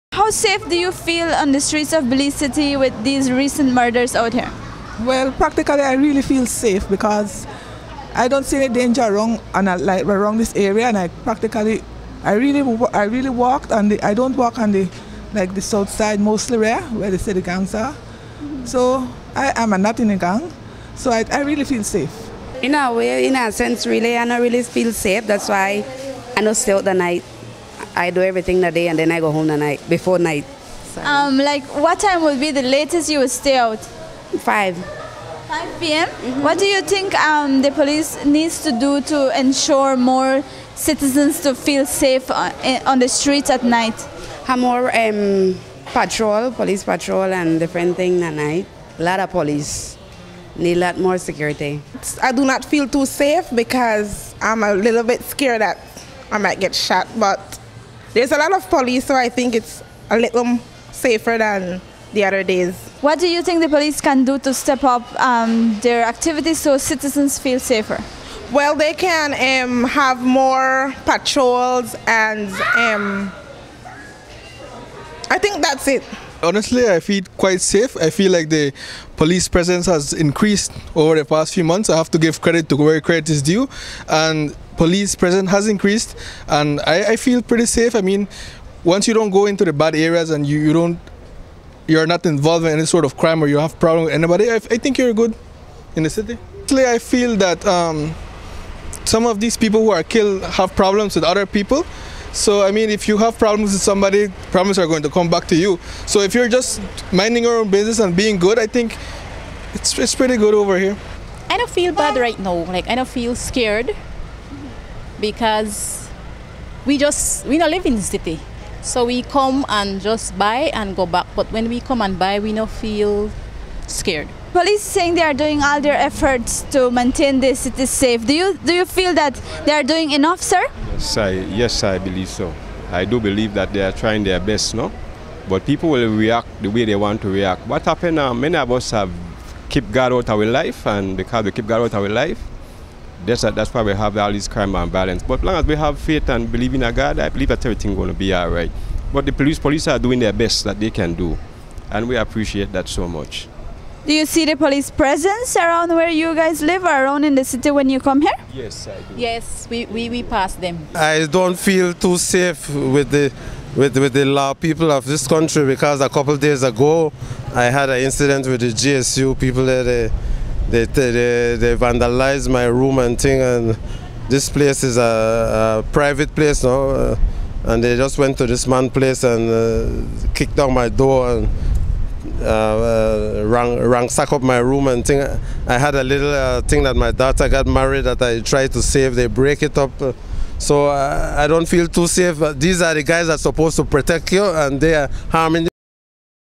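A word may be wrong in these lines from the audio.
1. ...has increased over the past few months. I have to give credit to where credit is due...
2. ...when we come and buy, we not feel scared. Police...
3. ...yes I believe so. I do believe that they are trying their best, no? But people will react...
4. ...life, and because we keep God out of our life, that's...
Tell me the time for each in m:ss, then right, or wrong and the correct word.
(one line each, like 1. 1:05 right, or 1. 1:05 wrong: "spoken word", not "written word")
1. 1:19 right
2. 2:01 right
3. 2:11 right
4. 2:20 right.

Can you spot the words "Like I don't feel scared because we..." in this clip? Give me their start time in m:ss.
1:52.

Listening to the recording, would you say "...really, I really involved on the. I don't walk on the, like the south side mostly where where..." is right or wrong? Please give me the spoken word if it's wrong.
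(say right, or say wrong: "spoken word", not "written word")
wrong: "walked", not "involved".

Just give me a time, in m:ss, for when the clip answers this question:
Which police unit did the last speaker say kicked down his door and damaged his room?
2:48.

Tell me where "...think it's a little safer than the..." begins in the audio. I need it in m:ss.
0:59.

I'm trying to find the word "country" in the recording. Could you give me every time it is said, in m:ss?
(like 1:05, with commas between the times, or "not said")
2:45.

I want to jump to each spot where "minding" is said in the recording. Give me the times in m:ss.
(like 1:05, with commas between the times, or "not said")
1:47.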